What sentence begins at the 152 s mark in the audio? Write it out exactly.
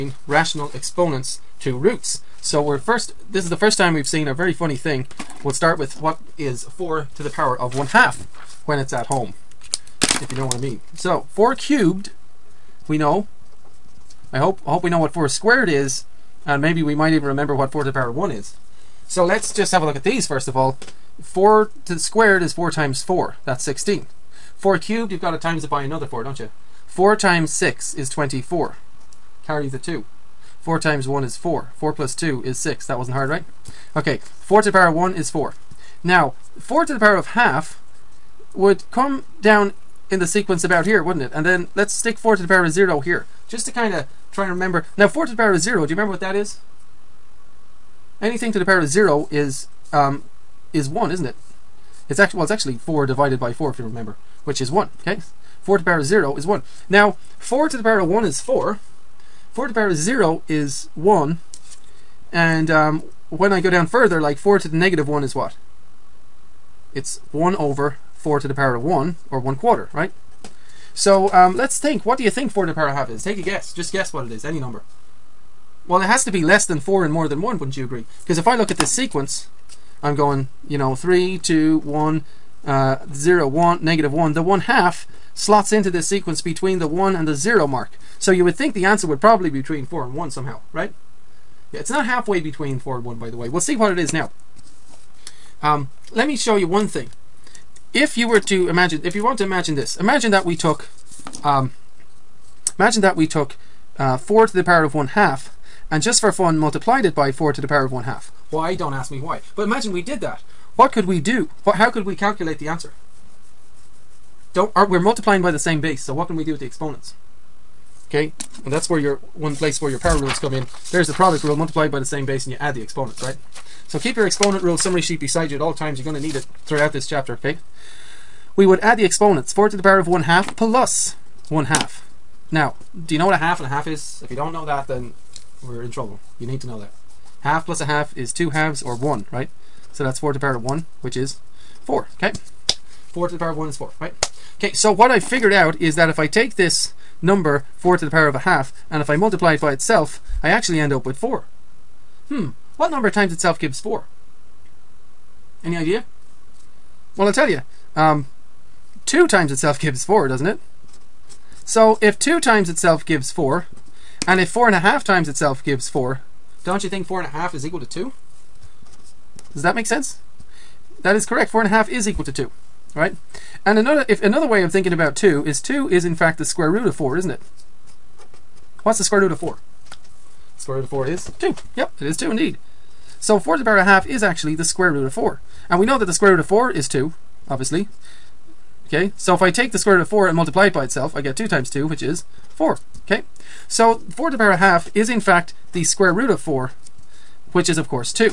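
Hmm, what number times itself gives 4?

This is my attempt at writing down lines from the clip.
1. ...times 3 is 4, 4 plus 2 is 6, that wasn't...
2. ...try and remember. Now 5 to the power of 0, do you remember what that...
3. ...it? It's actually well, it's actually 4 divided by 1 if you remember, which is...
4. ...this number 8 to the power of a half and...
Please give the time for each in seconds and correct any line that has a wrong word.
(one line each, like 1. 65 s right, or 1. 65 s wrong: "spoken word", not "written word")
1. 30 s wrong: "1", not "3"
2. 44 s wrong: "4", not "5"
3. 51 s wrong: "4", not "1"
4. 146 s wrong: "4", not "8".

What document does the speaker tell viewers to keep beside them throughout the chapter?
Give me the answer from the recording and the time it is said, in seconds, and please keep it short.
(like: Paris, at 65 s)
exponent rule summary sheet, at 124 s.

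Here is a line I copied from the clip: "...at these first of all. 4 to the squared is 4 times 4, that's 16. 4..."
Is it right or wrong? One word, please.
right.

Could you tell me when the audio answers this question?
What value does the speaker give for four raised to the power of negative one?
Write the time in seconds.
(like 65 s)
69 s.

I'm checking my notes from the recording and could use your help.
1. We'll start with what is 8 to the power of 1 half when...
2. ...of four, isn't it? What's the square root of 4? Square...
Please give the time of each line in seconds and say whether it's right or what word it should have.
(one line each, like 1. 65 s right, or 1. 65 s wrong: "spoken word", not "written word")
1. 5 s wrong: "4", not "8"
2. 176 s right.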